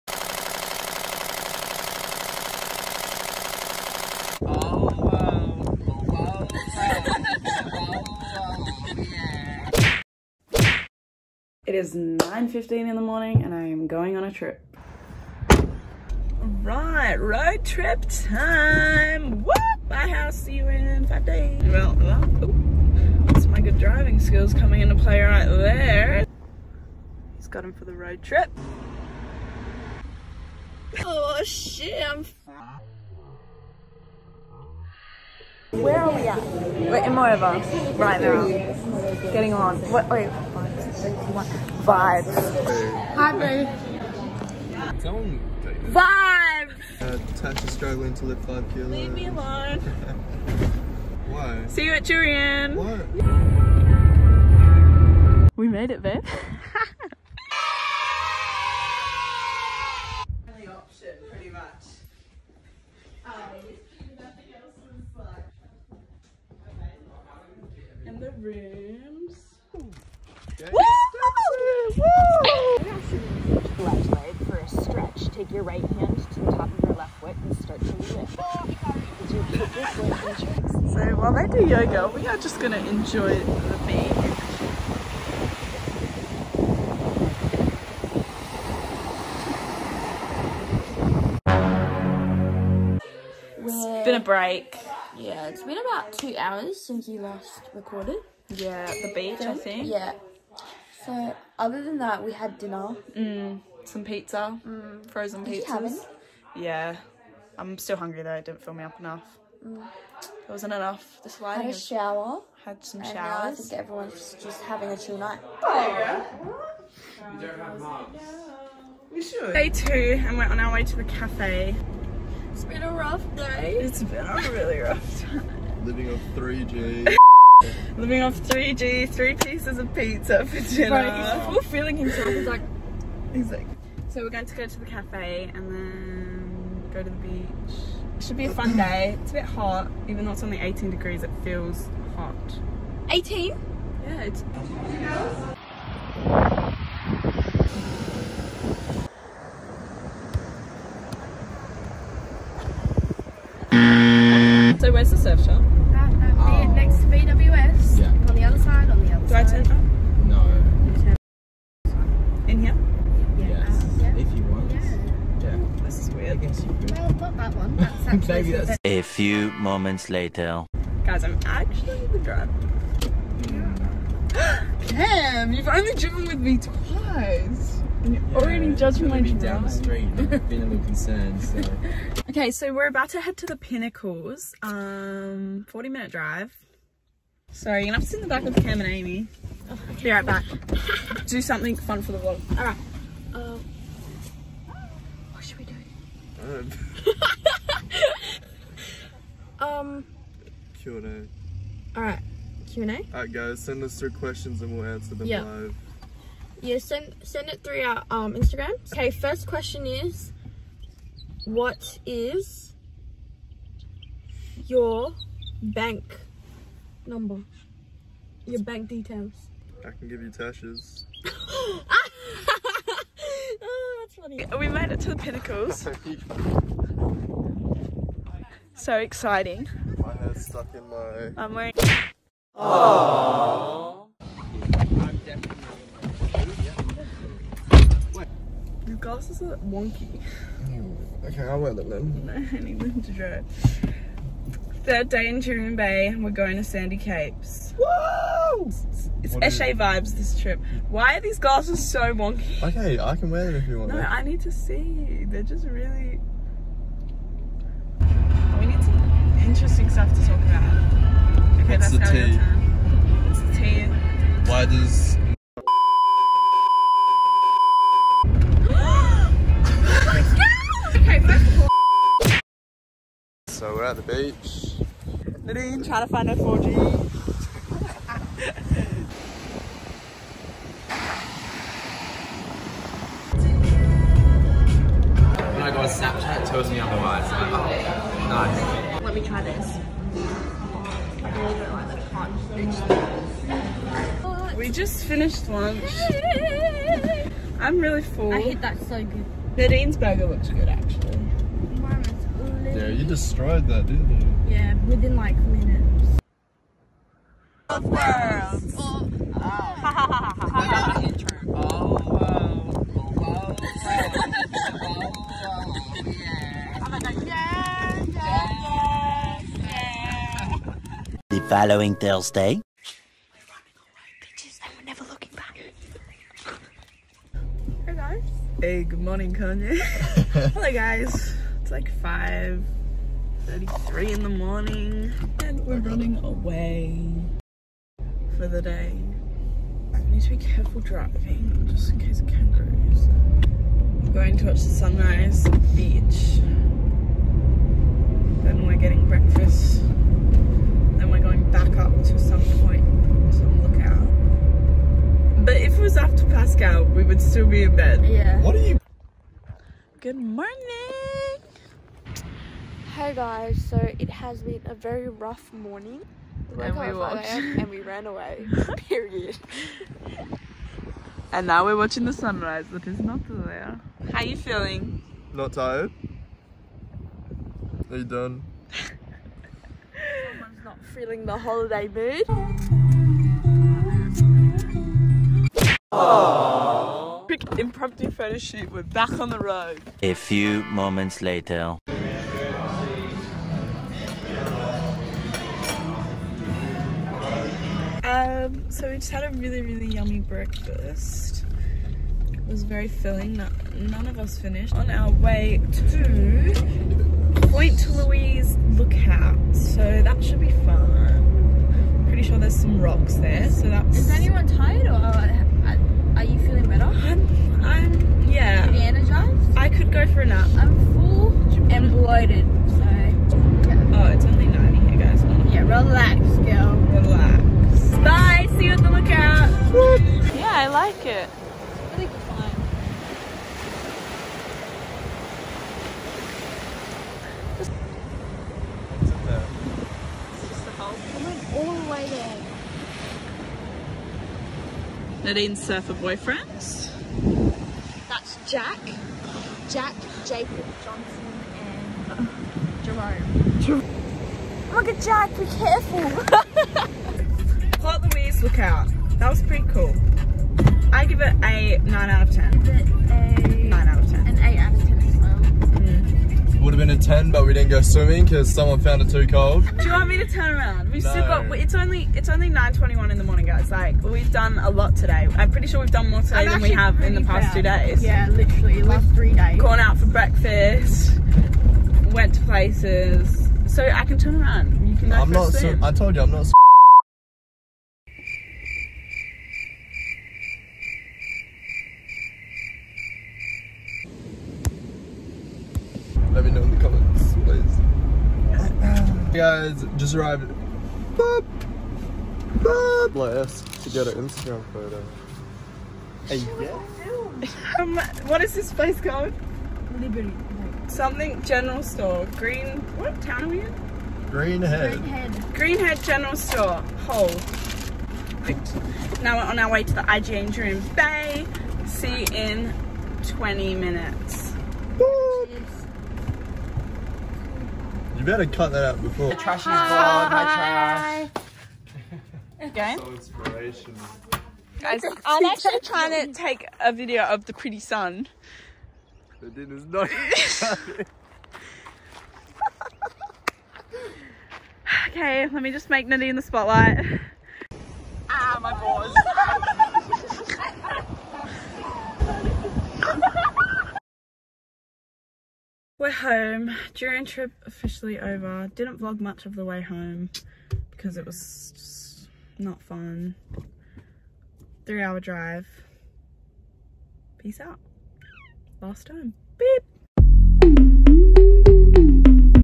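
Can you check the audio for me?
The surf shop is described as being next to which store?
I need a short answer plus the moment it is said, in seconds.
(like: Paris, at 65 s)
BWS, at 157 s.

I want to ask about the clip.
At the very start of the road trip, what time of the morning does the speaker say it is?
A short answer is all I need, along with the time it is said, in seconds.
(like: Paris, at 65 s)
9:15, at 11 s.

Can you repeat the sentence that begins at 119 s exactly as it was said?
Day two, and we're on our way to the cafe.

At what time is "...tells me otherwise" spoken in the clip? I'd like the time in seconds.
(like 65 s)
286 s.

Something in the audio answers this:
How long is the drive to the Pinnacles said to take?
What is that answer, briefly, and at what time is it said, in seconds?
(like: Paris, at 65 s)
40 minutes, at 185 s.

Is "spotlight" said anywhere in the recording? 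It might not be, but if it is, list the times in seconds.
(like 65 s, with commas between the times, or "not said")
546 s.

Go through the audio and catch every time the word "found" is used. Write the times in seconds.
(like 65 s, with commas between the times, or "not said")
468 s.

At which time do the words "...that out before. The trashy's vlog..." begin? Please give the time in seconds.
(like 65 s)
528 s.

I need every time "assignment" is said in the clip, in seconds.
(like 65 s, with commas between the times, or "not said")
not said.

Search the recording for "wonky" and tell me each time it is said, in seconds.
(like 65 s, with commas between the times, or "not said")
239 s, 252 s.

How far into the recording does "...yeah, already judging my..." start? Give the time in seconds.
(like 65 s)
178 s.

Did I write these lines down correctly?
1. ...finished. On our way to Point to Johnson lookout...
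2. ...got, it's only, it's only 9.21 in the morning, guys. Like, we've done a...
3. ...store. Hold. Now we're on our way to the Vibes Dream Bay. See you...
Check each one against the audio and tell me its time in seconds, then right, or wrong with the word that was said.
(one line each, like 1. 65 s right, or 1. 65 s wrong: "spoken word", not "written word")
1. 404 s wrong: "Louise", not "Johnson"
2. 471 s right
3. 516 s wrong: "IGN", not "Vibes".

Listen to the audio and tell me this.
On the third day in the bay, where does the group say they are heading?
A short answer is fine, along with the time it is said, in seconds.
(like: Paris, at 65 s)
Sandy Capes, at 246 s.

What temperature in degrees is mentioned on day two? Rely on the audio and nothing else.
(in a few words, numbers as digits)
18.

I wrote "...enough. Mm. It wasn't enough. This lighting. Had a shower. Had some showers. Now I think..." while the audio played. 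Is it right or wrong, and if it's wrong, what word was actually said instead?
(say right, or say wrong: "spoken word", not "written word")
right.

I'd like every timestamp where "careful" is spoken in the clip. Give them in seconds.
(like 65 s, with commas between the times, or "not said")
340 s, 455 s.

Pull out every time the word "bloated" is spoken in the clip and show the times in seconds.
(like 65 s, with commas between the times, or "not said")
421 s.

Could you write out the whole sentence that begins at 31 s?
Oh shit, I'm where are we at?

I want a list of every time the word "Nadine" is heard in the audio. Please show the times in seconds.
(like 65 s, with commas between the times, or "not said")
275 s, 299 s, 445 s, 546 s.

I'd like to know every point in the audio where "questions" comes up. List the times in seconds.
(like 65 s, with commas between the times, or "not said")
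204 s, 209 s.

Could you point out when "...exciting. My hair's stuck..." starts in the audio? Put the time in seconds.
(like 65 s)
228 s.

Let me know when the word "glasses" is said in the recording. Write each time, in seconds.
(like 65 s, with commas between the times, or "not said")
238 s, 251 s.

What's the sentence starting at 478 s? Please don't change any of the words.
Yeah, literally, last We've three days.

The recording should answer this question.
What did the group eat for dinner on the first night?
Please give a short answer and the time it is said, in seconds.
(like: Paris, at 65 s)
frozen pizzas, at 105 s.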